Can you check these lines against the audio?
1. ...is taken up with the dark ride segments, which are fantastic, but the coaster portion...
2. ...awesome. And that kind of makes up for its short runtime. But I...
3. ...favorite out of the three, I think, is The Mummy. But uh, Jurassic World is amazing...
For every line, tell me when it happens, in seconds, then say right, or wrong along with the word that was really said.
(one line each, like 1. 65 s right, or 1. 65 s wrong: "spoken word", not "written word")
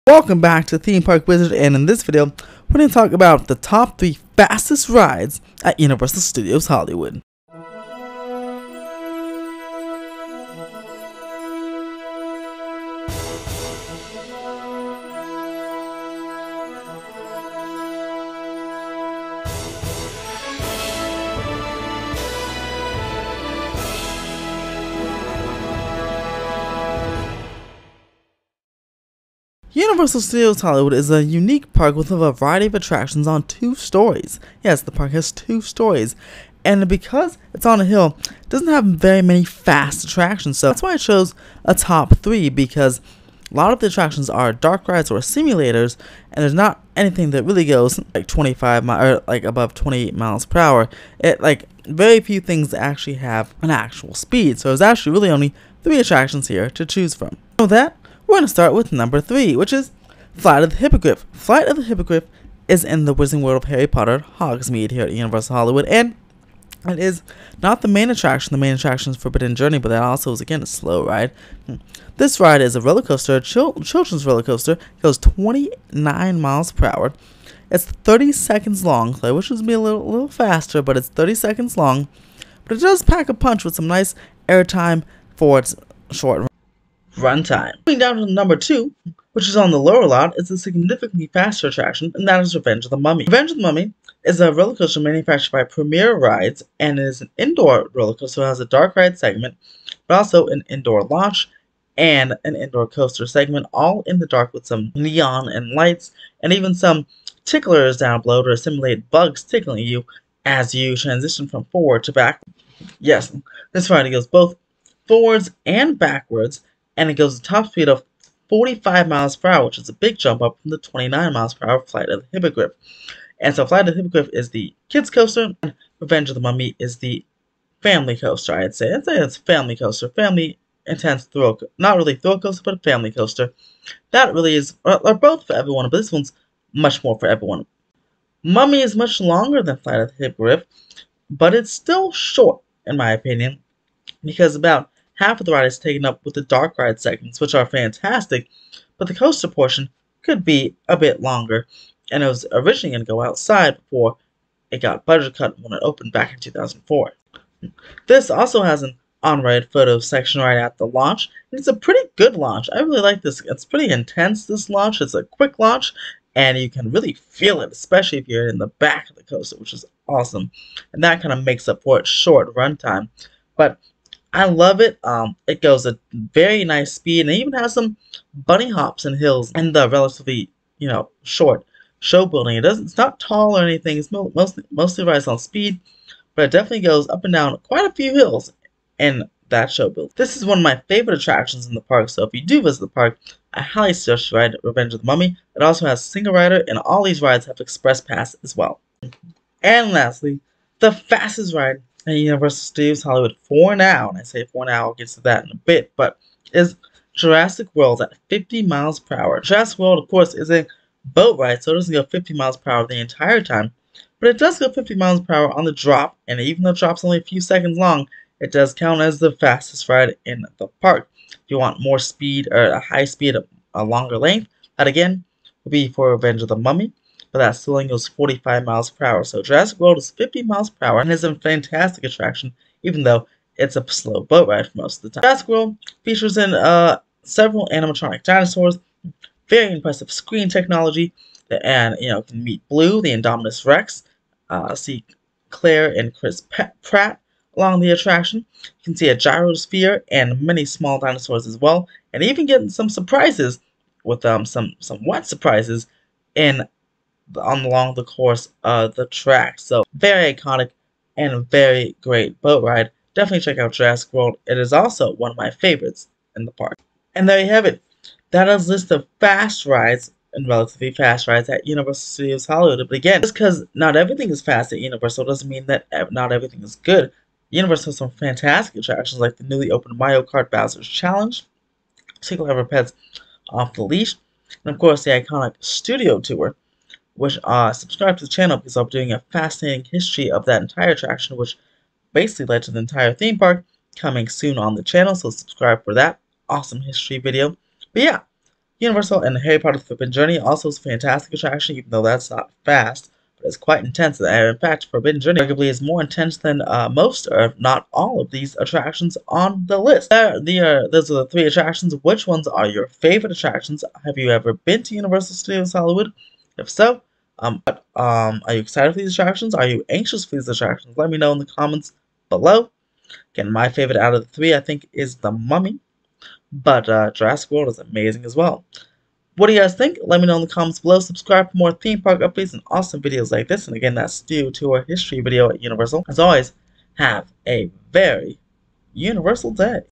1. 145 s right
2. 170 s right
3. 323 s right.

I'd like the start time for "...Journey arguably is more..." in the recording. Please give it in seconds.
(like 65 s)
305 s.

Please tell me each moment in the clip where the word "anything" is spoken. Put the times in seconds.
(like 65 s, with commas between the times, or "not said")
46 s, 183 s.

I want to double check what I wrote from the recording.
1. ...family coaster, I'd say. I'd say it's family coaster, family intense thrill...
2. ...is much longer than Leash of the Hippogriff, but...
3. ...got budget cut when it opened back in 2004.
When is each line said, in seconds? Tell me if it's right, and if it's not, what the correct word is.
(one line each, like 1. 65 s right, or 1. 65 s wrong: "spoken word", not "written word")
1. 127 s right
2. 138 s wrong: "Flight", not "Leash"
3. 154 s right.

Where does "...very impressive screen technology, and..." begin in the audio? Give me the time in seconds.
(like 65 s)
239 s.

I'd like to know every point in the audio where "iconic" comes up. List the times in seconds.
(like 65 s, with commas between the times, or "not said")
260 s, 285 s.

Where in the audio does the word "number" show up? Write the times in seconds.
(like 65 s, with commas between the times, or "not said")
58 s, 88 s.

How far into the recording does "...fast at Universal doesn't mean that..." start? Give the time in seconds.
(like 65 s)
274 s.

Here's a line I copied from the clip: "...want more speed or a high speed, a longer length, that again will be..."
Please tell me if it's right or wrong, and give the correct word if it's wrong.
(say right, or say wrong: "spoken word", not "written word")
right.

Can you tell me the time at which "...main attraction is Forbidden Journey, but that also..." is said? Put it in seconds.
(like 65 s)
68 s.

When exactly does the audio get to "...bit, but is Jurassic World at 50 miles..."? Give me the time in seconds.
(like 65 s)
205 s.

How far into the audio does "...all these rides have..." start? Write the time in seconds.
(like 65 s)
196 s.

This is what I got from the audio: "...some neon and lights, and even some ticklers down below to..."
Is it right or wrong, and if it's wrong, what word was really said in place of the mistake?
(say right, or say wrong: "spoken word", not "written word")
right.